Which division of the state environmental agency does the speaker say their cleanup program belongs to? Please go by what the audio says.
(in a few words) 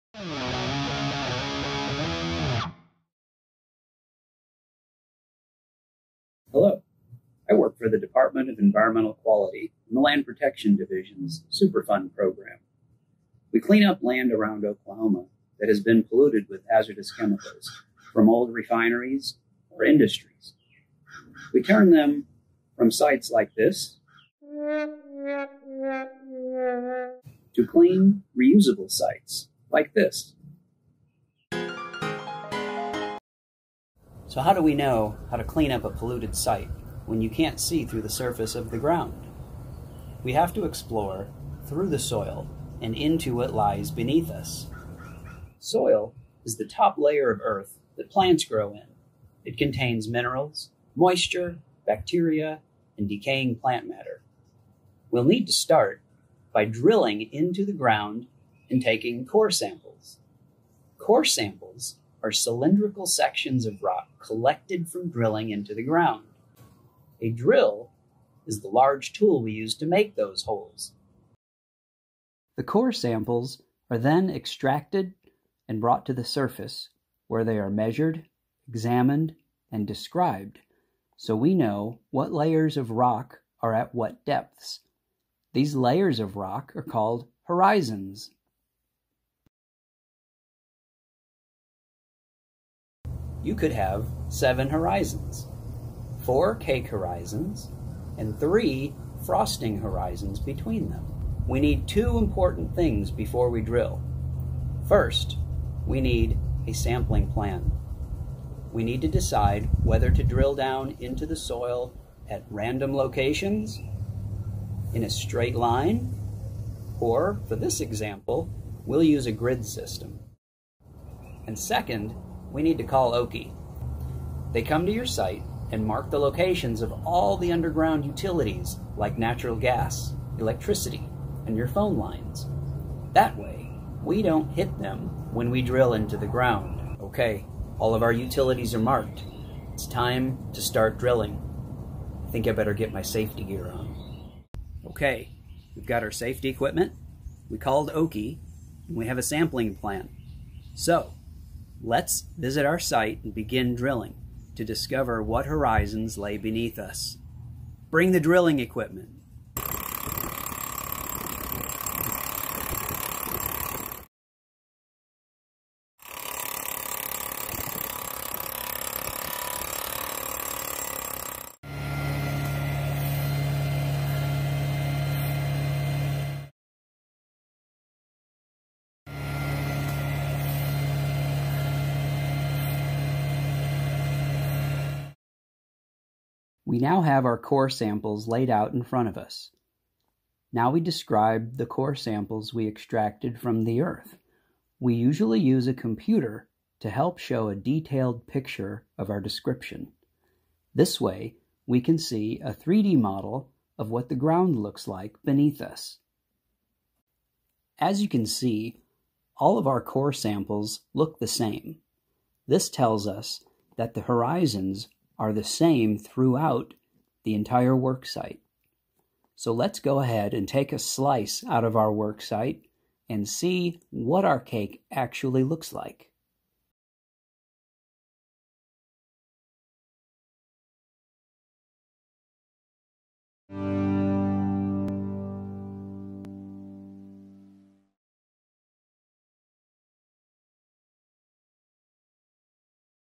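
Land Protection Division.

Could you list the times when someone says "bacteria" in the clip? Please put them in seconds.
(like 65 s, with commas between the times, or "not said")
51 s.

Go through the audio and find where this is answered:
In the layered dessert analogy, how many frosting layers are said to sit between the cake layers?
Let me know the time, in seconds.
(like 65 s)
98 s.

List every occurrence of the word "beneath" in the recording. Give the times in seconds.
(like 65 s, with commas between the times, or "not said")
43 s, 156 s, 205 s.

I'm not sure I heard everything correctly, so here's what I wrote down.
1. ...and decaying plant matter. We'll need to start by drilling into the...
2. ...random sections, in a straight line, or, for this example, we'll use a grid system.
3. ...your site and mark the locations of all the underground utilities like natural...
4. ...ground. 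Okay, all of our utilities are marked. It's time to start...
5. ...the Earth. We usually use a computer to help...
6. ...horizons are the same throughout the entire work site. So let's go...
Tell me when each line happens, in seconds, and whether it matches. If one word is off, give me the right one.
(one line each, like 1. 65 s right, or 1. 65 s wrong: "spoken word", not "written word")
1. 52 s right
2. 112 s wrong: "locations", not "sections"
3. 124 s right
4. 136 s right
5. 193 s right
6. 214 s right.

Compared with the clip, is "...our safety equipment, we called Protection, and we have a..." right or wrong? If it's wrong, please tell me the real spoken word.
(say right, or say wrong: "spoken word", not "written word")
wrong: "OKIE", not "Protection".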